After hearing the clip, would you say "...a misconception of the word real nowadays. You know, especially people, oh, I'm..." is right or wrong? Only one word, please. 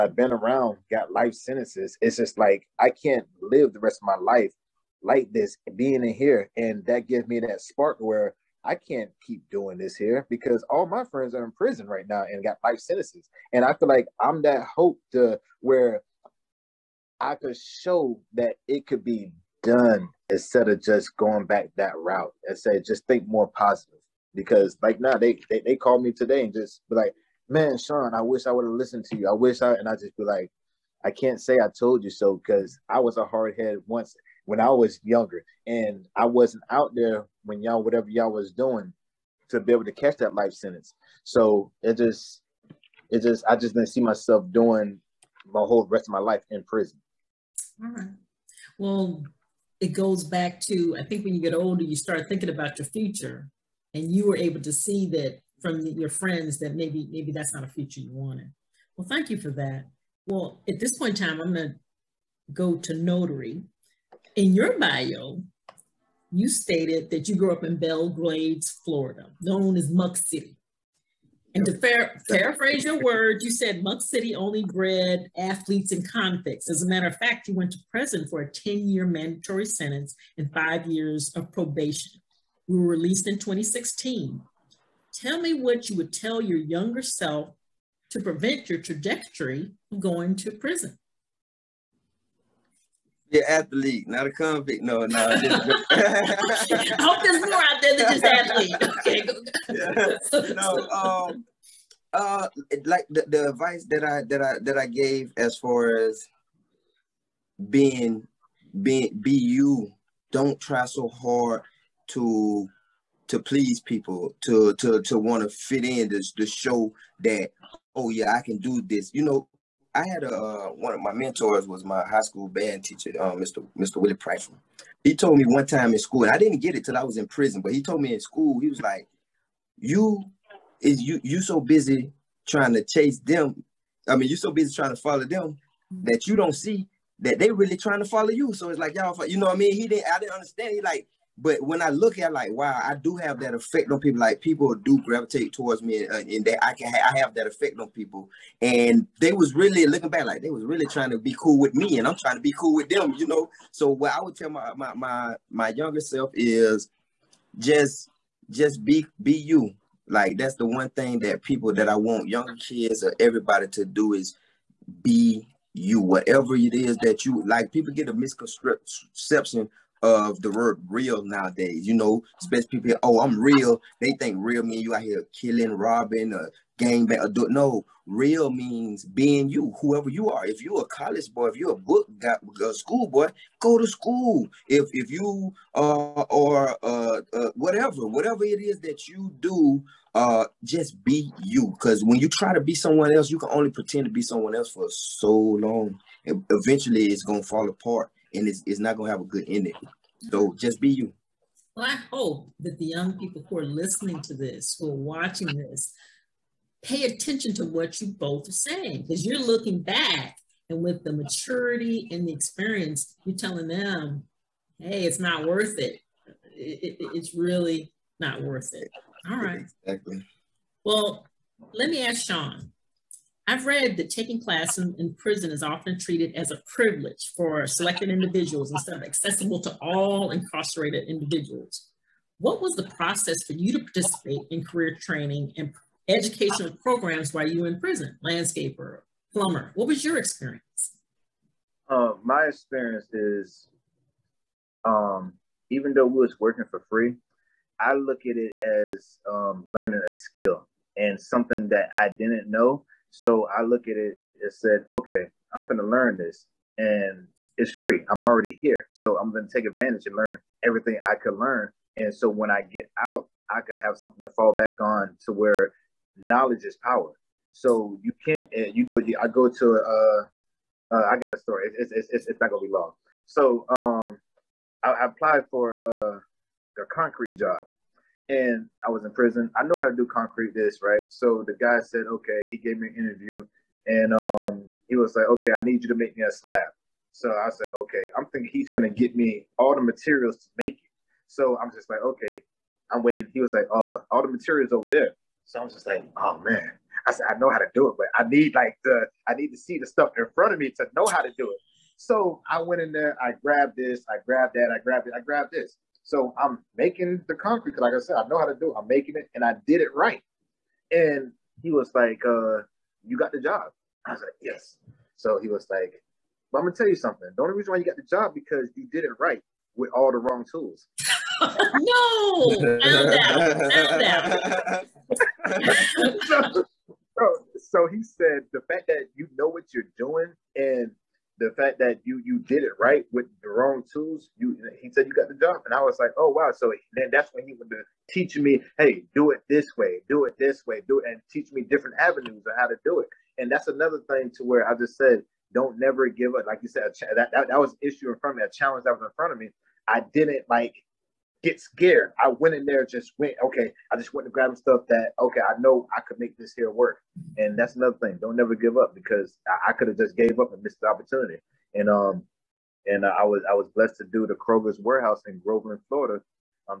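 right.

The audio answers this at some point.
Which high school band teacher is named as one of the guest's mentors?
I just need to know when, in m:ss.
2:03.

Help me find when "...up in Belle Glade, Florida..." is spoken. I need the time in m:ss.
1:07.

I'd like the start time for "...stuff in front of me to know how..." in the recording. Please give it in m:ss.
4:59.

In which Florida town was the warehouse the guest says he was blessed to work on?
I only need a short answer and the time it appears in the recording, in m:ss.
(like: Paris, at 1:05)
Groveland, at 6:05.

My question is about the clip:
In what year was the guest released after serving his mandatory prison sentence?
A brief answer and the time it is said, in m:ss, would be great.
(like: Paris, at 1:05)
2016, at 1:23.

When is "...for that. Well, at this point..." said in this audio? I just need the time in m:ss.
0:59.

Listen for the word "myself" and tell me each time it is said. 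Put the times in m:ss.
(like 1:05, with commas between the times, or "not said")
0:44.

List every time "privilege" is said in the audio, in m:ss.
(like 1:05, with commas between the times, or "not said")
3:46.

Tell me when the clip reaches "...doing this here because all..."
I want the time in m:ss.
0:09.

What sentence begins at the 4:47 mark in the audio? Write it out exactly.
So I said, okay, I'm thinking he's gonna get me all the materials to make it.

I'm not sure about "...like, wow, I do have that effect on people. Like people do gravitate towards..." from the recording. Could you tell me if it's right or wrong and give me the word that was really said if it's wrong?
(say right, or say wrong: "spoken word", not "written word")
right.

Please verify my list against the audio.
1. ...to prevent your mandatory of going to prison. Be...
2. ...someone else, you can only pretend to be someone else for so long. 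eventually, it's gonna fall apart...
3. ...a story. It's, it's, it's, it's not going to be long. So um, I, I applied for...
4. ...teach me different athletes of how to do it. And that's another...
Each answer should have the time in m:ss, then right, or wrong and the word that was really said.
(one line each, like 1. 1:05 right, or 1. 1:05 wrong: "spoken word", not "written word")
1. 1:28 wrong: "trajectory", not "mandatory"
2. 3:12 right
3. 4:31 right
4. 5:41 wrong: "avenues", not "athletes".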